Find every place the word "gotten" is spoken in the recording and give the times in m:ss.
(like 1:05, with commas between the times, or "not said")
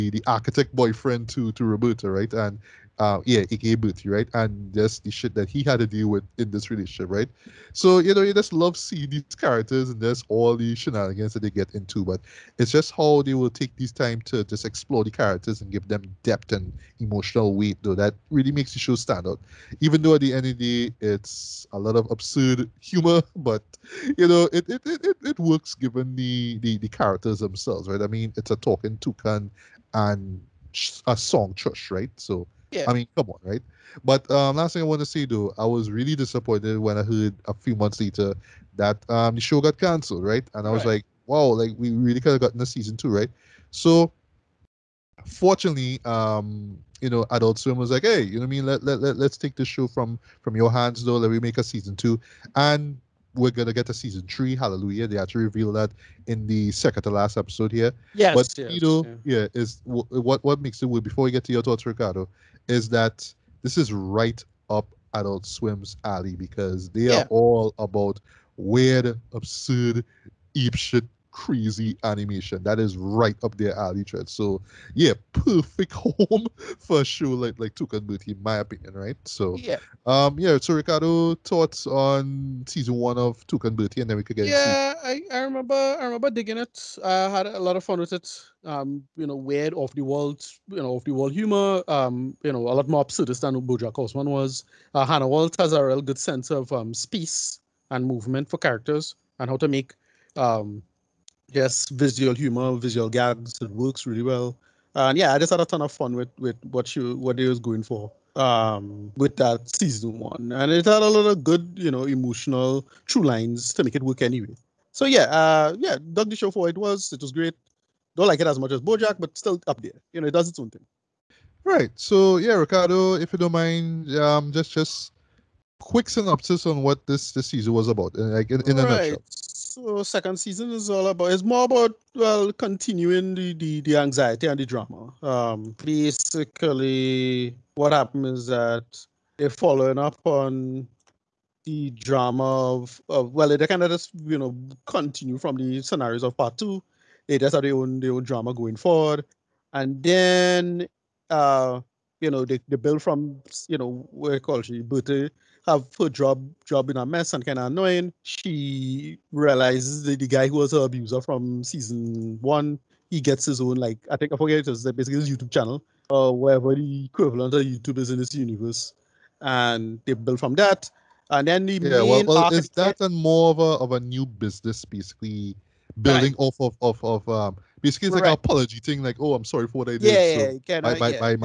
0:42.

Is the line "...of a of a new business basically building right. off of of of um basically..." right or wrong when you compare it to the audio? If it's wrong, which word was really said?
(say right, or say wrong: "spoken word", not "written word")
right.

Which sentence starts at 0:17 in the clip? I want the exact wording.
That really makes the show stand out.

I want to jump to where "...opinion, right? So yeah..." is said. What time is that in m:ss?
1:18.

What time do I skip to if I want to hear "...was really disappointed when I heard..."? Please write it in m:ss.
0:35.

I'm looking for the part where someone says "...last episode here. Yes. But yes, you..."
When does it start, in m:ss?
0:57.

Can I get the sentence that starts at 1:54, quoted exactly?
So yeah, uh, yeah, dug the show for it was.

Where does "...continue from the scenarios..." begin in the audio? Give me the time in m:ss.
2:24.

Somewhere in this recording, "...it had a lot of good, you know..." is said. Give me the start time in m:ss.
1:50.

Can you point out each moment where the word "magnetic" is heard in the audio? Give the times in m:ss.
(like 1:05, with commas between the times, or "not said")
not said.